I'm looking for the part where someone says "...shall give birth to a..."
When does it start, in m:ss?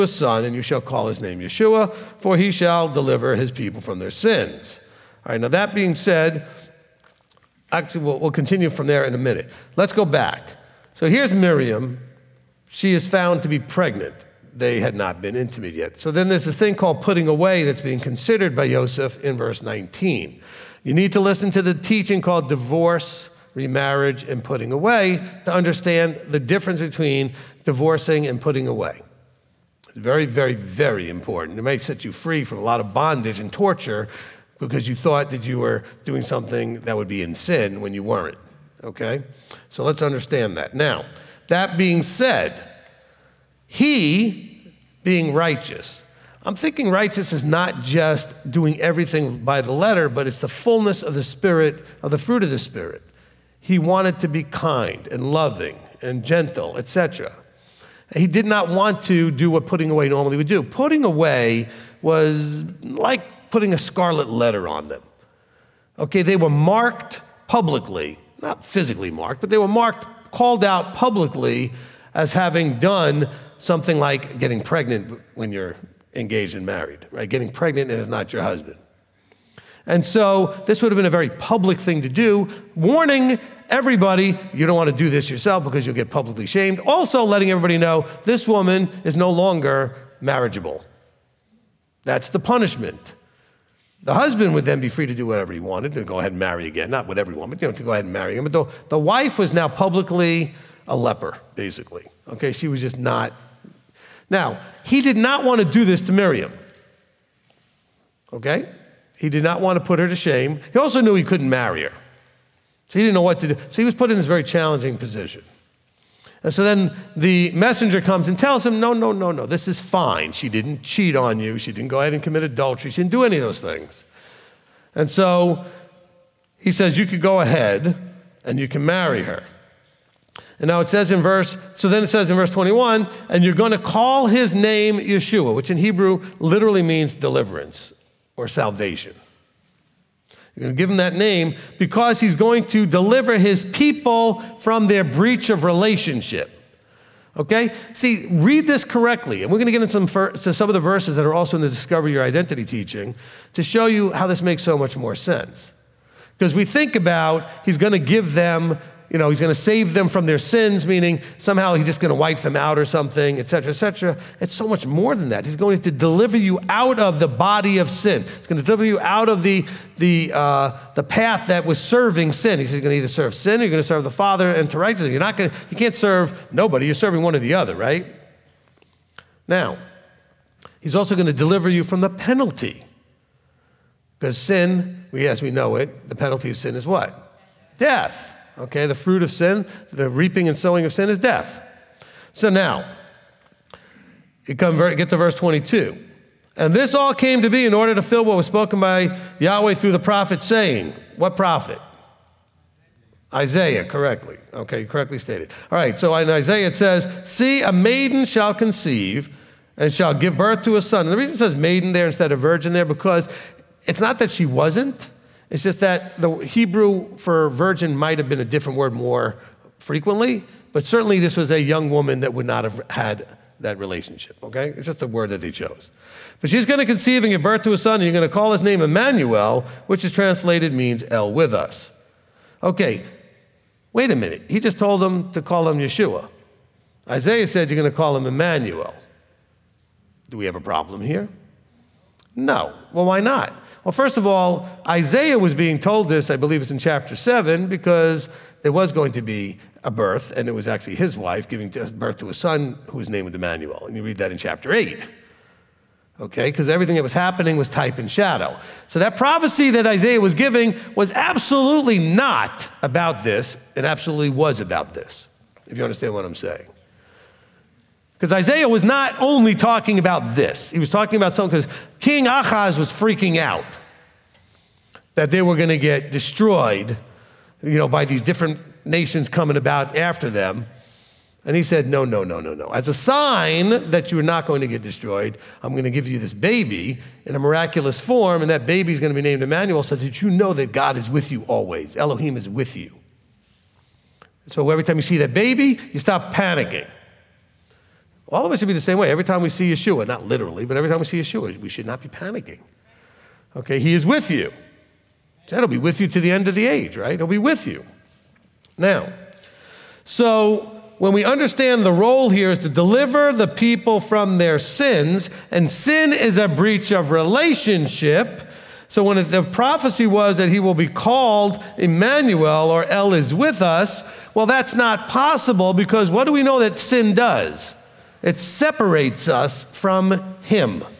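3:29.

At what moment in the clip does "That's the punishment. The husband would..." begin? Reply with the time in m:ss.
1:32.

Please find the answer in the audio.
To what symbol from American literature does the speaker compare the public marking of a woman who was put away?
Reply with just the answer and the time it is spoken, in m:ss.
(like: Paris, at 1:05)
a scarlet letter, at 1:03.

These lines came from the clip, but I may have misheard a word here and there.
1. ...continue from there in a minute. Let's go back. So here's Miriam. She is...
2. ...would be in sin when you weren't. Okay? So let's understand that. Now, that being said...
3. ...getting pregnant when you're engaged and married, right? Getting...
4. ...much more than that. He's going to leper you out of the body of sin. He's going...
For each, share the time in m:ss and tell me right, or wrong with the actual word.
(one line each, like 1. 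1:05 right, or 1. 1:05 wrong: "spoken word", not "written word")
1. 0:08 right
2. 0:36 right
3. 1:14 right
4. 2:44 wrong: "deliver", not "leper".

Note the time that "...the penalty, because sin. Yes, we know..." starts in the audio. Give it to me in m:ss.
3:02.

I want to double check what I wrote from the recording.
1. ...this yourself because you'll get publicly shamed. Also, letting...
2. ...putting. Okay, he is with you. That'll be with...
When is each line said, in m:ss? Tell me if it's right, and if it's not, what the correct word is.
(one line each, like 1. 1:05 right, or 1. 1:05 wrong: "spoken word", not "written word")
1. 1:25 right
2. 5:02 wrong: "panicking", not "putting".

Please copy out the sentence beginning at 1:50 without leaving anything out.
He also knew he couldn't marry her.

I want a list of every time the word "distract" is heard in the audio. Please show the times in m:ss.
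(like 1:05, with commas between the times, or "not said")
not said.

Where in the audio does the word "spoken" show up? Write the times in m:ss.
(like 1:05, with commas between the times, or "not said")
3:18.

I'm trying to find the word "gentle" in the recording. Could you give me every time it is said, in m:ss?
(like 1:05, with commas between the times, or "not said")
0:56.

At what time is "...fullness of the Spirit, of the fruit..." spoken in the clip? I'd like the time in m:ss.
0:50.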